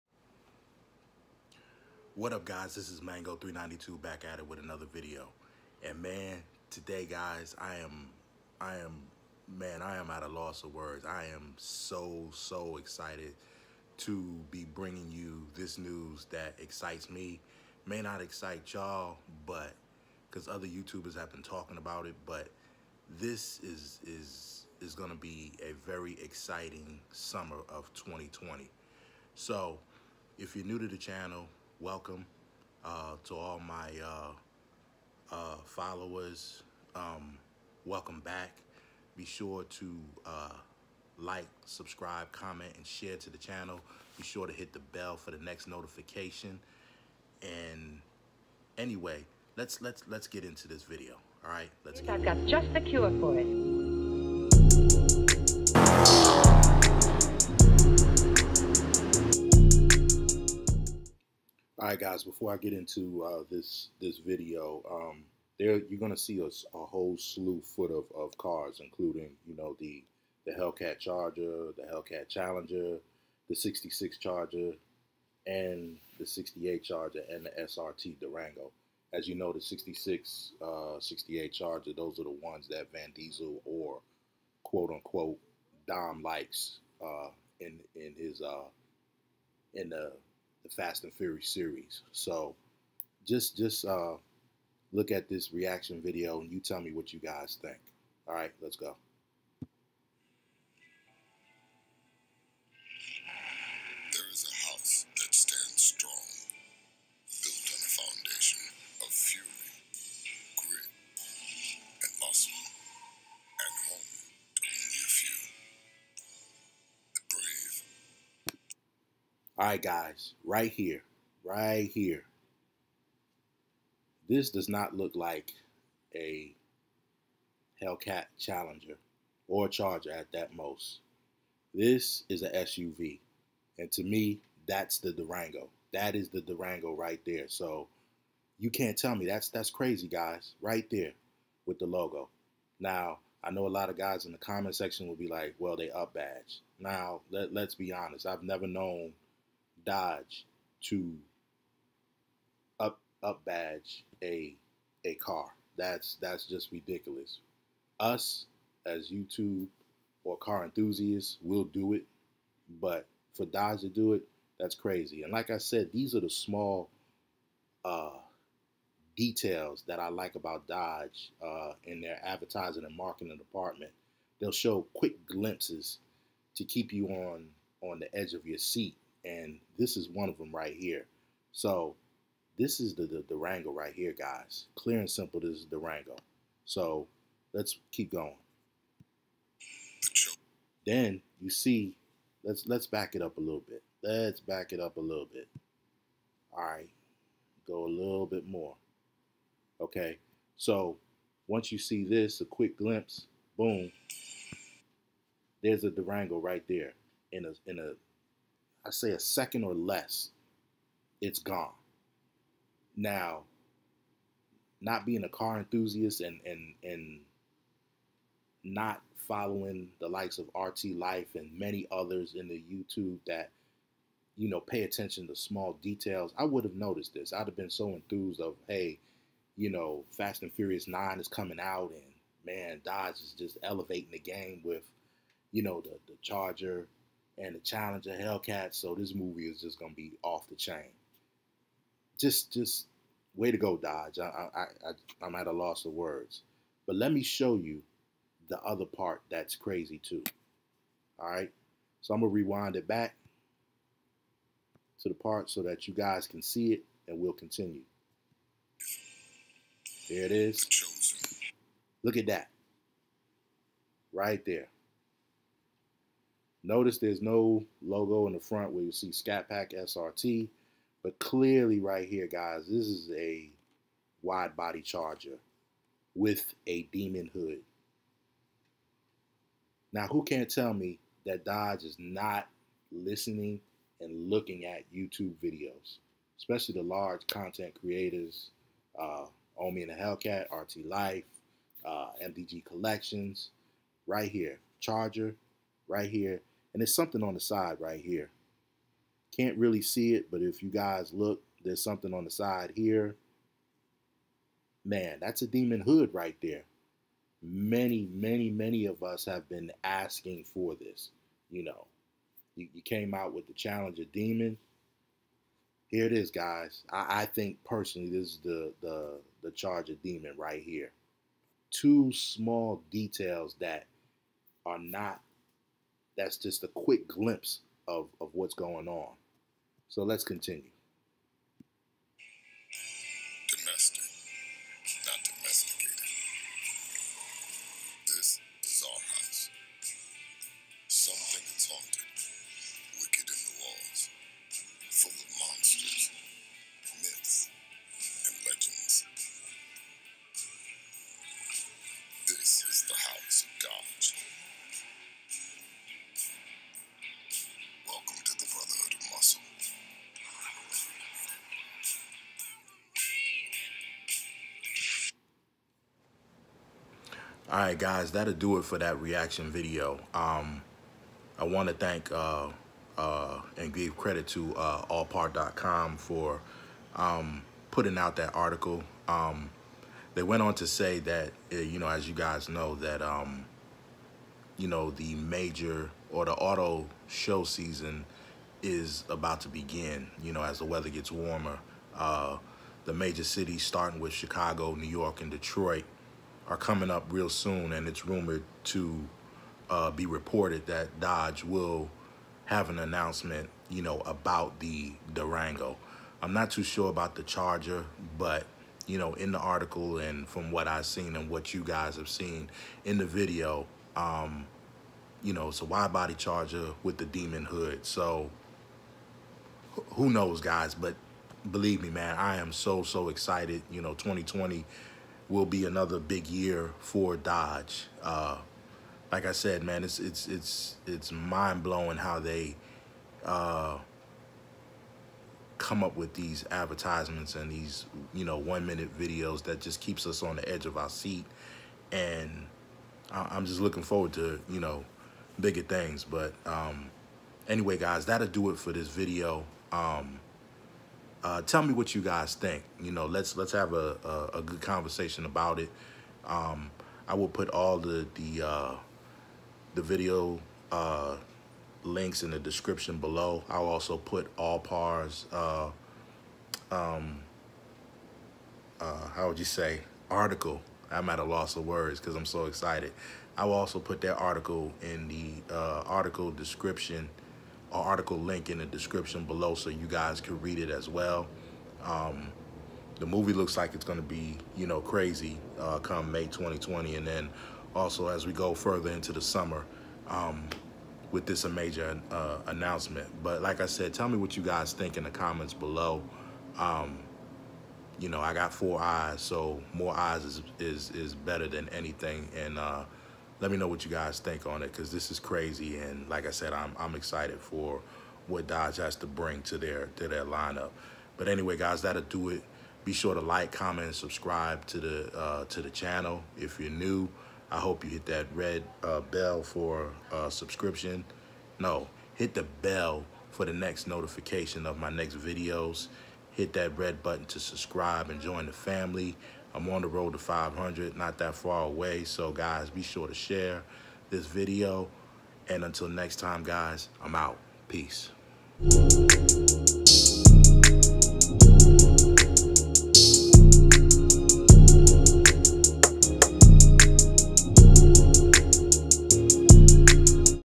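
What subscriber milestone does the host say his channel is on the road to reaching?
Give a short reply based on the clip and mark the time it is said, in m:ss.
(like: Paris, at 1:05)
500, at 8:50.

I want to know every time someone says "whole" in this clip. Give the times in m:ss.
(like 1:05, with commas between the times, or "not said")
1:06.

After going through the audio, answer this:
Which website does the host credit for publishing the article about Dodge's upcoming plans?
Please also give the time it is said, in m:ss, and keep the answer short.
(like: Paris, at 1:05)
allpar.com, at 6:14.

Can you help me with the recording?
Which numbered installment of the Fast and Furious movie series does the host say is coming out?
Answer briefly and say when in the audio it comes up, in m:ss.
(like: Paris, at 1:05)
Nine, at 3:50.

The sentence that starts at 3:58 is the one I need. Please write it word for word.
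So this movie is just gonna be off the chain.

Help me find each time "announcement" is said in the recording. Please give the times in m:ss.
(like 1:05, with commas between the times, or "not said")
6:42, 8:12.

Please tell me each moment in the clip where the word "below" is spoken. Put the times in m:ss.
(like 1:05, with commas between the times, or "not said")
7:42, 7:59, 8:15.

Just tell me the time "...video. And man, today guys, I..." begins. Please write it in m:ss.
0:04.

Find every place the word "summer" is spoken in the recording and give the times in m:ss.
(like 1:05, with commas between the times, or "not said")
0:27, 8:09.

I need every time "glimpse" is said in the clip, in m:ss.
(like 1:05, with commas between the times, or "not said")
2:55, 3:22, 5:27.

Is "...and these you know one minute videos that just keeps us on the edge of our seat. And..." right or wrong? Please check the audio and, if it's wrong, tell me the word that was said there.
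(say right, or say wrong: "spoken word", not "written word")
right.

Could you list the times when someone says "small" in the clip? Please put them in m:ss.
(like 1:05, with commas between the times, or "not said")
2:46, 3:45, 5:22.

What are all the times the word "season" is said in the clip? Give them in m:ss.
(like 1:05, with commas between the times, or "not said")
6:27.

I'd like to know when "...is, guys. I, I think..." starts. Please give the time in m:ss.
5:16.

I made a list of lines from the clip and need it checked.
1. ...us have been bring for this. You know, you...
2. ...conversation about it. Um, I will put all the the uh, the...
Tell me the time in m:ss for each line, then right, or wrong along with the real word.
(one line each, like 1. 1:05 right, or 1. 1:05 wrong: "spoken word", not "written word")
1. 5:09 wrong: "asking", not "bring"
2. 7:34 right.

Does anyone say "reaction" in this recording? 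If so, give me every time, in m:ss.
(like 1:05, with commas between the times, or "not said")
1:35, 6:09.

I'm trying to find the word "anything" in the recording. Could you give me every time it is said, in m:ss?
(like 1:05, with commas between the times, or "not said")
8:21.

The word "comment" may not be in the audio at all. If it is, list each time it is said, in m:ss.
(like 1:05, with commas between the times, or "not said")
0:42, 2:24, 8:15, 8:33.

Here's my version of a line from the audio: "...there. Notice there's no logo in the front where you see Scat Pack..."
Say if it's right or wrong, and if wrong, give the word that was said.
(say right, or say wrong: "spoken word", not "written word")
right.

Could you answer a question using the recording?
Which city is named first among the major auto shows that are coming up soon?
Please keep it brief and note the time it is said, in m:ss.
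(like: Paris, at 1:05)
Chicago, at 6:34.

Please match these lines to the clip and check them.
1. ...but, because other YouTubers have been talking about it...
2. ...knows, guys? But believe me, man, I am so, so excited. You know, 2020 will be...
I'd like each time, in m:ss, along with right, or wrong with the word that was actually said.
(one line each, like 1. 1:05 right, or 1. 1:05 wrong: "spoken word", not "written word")
1. 0:19 right
2. 7:00 right.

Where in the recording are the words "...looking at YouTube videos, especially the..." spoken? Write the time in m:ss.
4:44.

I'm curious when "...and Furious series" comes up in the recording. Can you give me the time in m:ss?
1:31.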